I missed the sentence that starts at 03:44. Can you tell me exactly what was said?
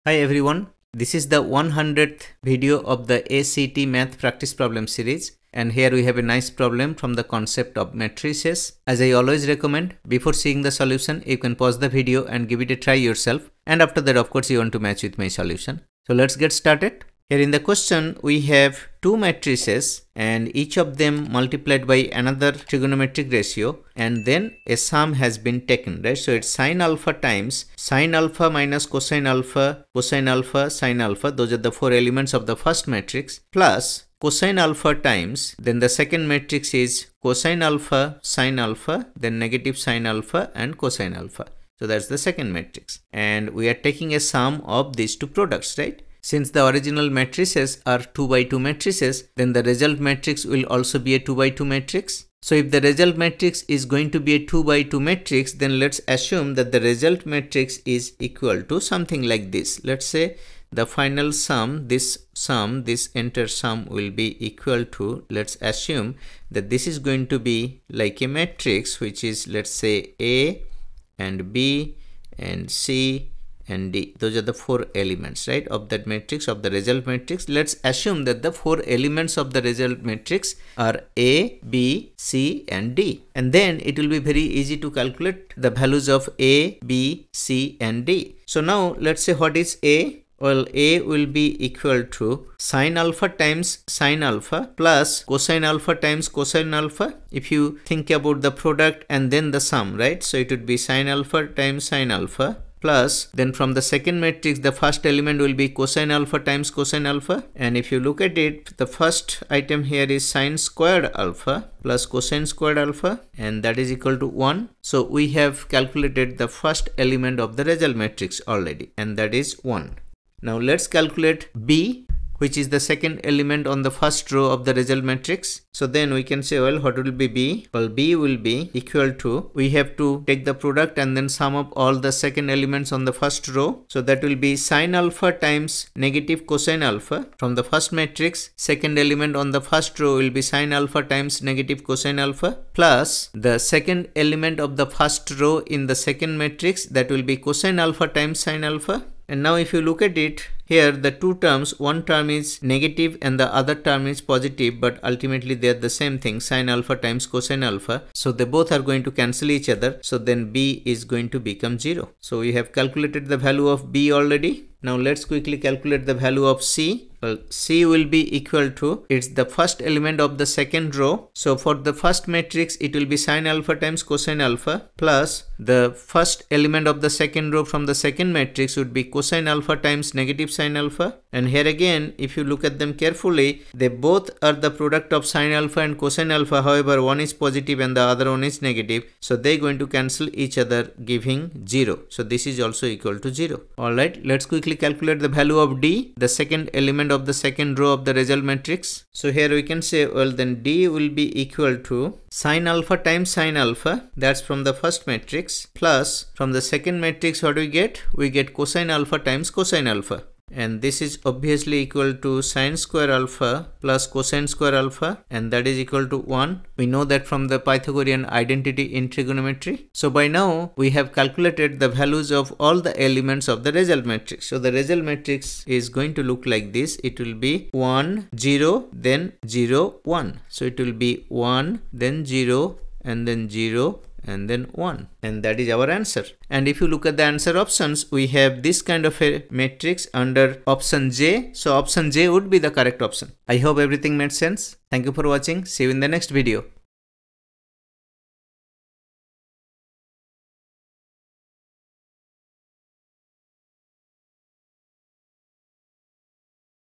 So the result matrix is going to look like this.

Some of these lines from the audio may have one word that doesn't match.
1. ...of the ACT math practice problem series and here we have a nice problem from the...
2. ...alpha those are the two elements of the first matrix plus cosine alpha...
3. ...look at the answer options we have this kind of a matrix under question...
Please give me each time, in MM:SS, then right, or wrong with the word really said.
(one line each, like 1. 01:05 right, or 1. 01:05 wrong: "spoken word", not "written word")
1. 00:02 right
2. 00:31 wrong: "four", not "two"
3. 03:56 wrong: "option", not "question".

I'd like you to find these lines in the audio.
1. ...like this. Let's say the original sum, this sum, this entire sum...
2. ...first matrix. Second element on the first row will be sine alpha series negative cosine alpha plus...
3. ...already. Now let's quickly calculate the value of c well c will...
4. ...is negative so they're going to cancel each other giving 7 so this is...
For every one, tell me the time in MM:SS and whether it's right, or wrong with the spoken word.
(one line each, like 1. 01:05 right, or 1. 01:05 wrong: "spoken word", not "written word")
1. 00:59 wrong: "final", not "original"
2. 02:17 wrong: "times", not "series"
3. 02:44 right
4. 03:08 wrong: "0", not "7".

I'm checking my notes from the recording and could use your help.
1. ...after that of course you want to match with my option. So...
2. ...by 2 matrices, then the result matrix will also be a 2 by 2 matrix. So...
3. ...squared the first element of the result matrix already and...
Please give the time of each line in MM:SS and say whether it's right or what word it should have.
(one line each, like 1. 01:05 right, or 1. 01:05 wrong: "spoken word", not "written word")
1. 00:13 wrong: "solution", not "option"
2. 00:48 right
3. 01:55 wrong: "calculated", not "squared".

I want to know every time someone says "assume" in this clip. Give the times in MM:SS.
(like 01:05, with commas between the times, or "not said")
00:56, 01:05, 01:17.